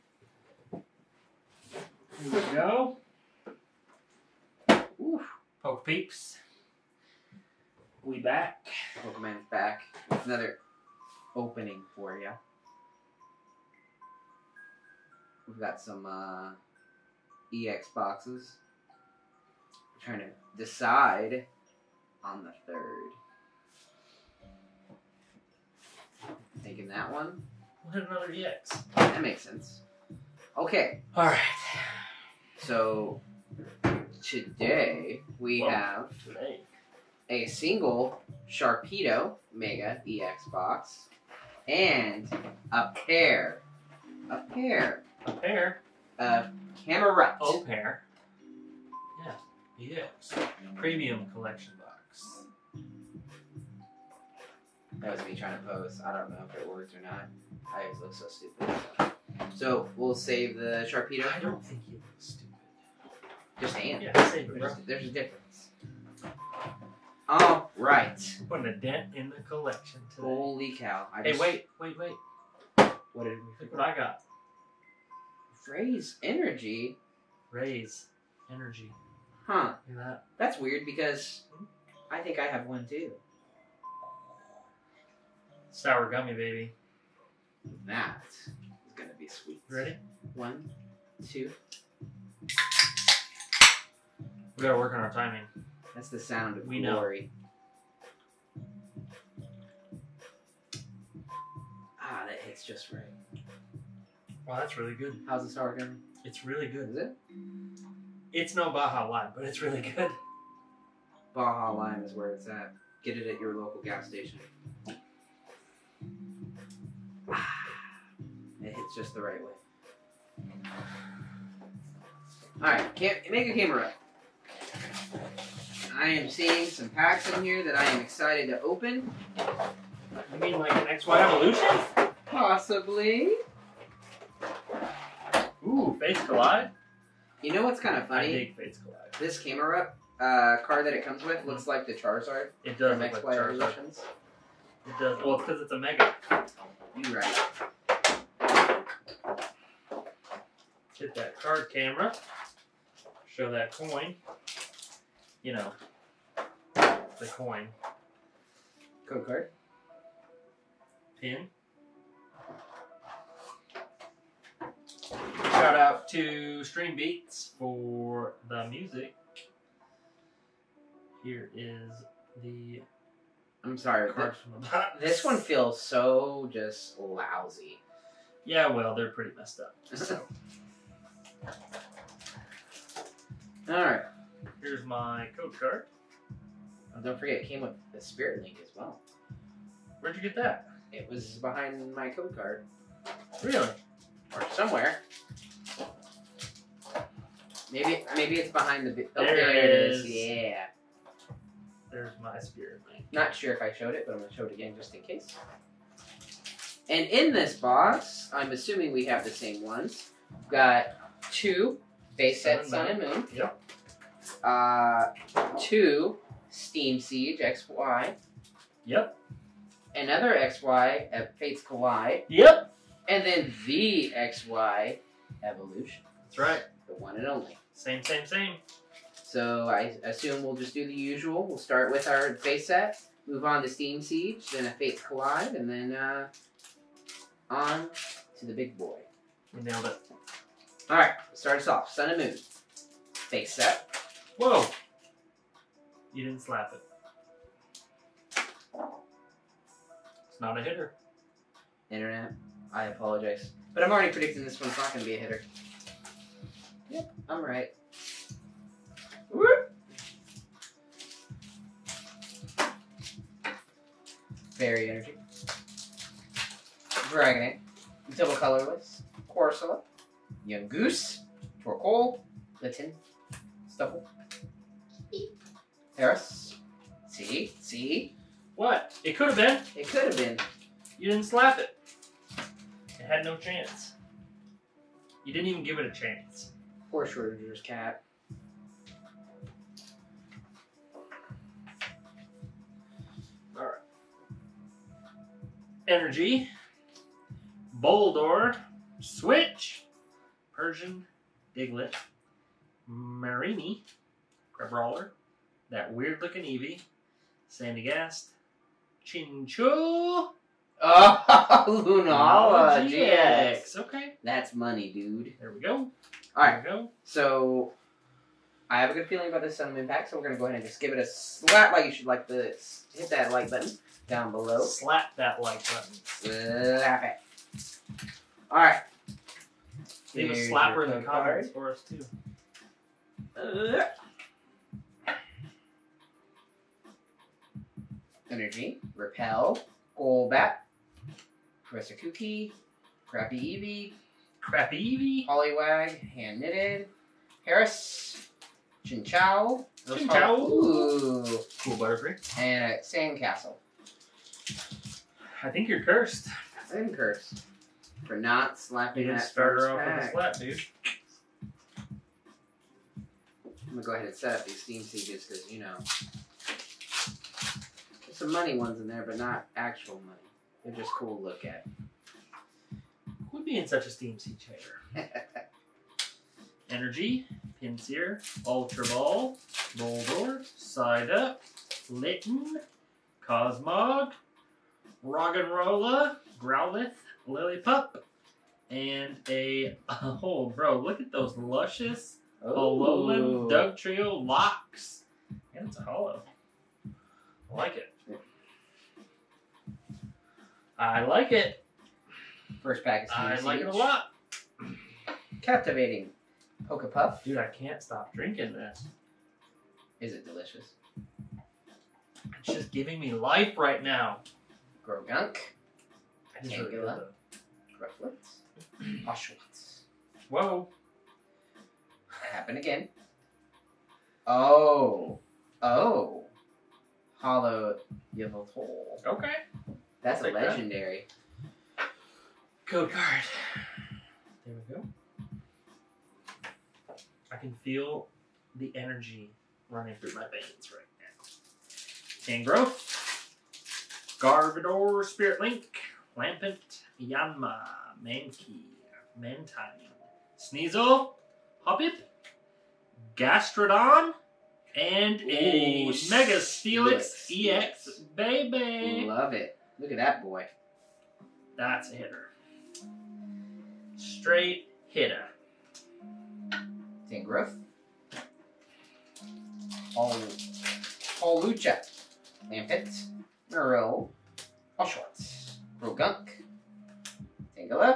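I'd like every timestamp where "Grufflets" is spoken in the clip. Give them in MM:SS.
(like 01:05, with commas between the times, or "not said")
06:57.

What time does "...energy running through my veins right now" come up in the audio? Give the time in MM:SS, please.
07:18.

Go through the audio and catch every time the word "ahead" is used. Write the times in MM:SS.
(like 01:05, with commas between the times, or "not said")
05:20, 06:03.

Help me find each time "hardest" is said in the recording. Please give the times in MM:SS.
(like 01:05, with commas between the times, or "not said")
not said.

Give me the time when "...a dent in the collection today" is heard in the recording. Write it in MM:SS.
01:08.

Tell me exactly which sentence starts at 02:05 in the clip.
I am seeing some packs in here that I am excited to open.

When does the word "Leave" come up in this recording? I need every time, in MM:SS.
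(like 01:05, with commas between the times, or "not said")
05:30.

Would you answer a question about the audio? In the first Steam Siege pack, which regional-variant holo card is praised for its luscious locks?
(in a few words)
Alolan Dugtrio.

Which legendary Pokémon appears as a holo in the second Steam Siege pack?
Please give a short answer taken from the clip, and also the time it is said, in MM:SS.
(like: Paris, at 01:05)
Yveltal, at 07:08.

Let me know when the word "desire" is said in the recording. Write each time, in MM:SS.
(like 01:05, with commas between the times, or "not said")
not said.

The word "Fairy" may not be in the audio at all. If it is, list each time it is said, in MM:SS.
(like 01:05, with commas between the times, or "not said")
04:24.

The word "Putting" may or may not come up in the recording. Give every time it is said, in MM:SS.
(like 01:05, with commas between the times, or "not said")
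01:08.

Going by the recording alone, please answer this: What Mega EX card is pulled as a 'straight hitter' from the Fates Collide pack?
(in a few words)
Mega Steelix EX.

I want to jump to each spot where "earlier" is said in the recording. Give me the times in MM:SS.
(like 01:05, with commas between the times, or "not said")
not said.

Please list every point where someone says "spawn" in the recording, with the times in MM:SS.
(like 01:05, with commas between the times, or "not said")
not said.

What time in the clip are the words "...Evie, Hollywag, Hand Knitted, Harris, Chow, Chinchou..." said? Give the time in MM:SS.
05:44.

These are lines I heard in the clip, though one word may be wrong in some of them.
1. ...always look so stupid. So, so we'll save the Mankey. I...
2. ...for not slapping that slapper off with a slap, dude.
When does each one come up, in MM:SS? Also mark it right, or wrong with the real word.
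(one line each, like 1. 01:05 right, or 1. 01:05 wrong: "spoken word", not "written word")
1. 00:57 wrong: "Sharpedo", not "Mankey"
2. 05:58 wrong: "starter", not "slapper".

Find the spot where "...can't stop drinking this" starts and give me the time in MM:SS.
06:47.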